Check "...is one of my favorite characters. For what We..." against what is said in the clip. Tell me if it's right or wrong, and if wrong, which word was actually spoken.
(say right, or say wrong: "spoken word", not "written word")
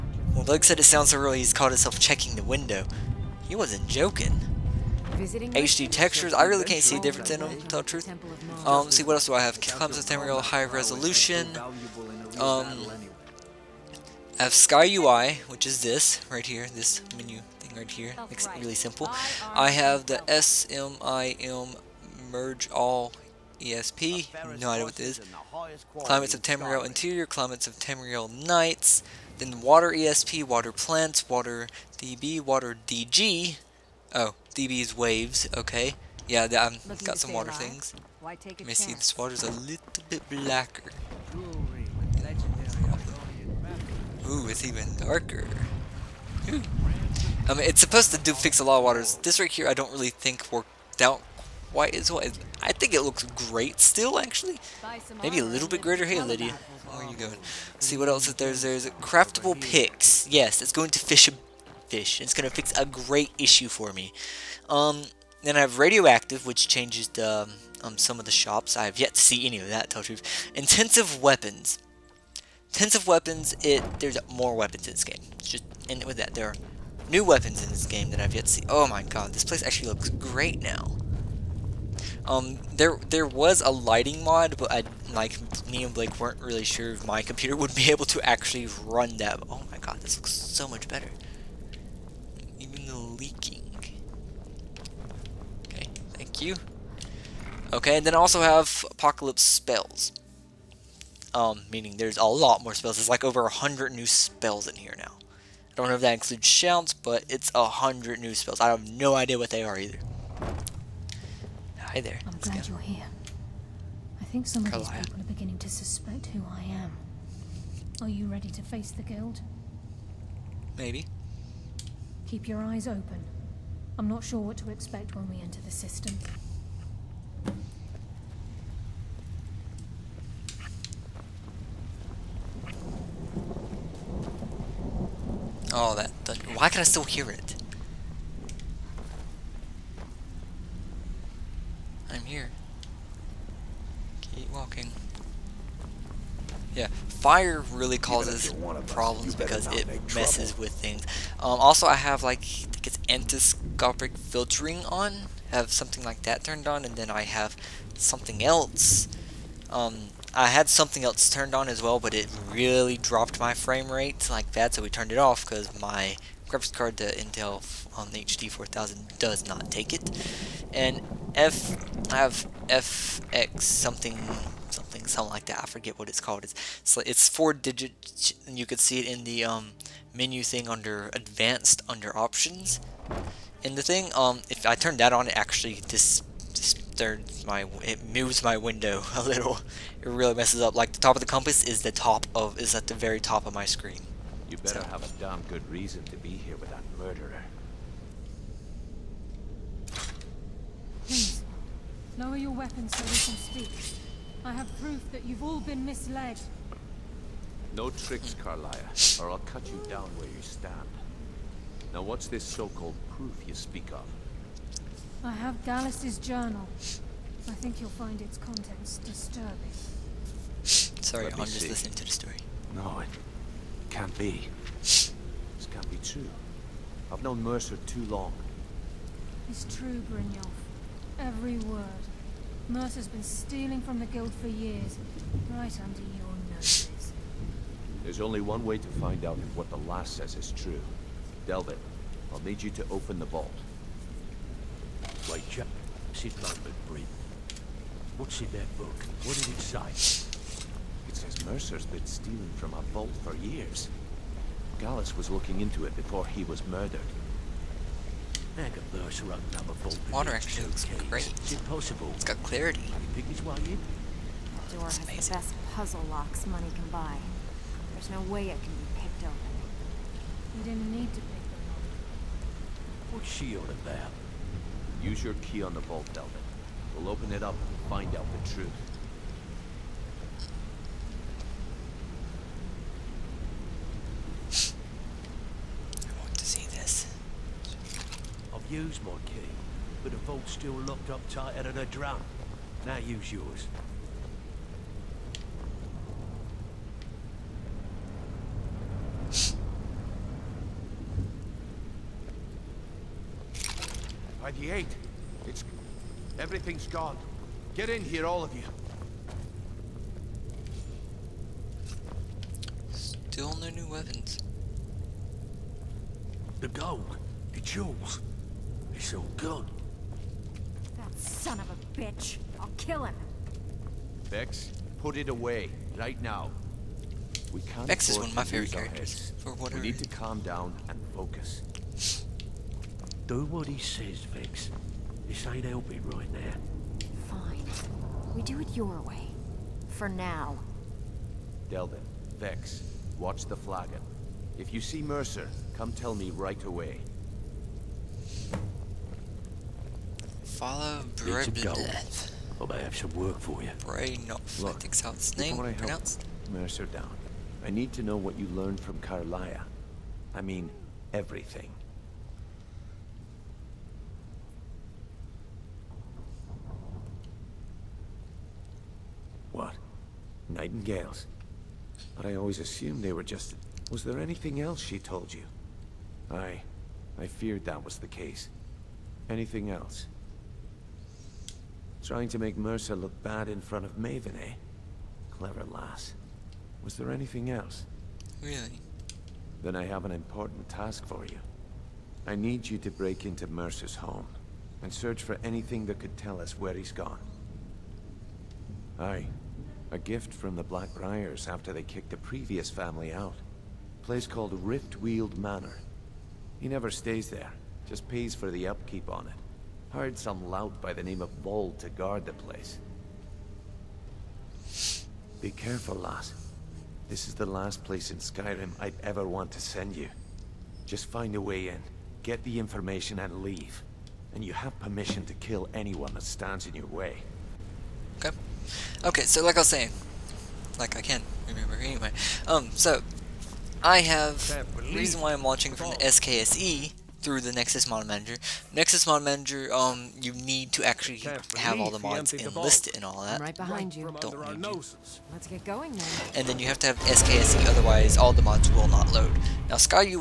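right.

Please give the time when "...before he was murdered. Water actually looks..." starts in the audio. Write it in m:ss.
4:15.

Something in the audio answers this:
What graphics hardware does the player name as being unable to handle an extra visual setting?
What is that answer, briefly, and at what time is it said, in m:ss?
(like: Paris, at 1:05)
Intel HD 4000, at 2:48.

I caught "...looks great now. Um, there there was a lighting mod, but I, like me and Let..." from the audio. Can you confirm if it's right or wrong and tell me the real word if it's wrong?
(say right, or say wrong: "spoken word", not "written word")
wrong: "Blake", not "Let".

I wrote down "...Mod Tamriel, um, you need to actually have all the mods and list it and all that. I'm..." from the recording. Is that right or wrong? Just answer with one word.
wrong.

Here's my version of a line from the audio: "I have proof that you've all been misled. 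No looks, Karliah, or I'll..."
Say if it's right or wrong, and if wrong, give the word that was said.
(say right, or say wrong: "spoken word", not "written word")
wrong: "tricks", not "looks".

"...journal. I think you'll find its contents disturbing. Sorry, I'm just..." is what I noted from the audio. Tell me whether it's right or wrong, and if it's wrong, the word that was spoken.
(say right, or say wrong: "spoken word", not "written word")
right.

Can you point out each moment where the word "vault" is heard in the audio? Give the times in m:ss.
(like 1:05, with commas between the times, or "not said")
4:03, 4:12, 4:35, 4:50.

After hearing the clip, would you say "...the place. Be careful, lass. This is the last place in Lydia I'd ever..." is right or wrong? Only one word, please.
wrong.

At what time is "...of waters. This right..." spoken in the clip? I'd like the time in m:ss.
0:48.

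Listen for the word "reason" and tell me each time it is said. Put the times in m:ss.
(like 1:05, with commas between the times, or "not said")
3:15, 7:14.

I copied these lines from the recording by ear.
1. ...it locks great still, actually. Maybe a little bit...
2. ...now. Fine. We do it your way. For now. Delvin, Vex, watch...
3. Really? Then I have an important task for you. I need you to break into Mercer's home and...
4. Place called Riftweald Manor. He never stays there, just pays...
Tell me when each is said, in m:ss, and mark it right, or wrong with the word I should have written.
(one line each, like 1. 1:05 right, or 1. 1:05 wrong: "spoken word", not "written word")
1. 0:52 wrong: "looks", not "locks"
2. 5:36 right
3. 6:28 right
4. 6:44 right.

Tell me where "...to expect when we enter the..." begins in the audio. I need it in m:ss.
2:04.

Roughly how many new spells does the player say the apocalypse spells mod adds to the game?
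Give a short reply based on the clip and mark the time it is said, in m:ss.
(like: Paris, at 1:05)
over 100, at 1:43.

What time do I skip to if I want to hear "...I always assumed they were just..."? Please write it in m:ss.
6:12.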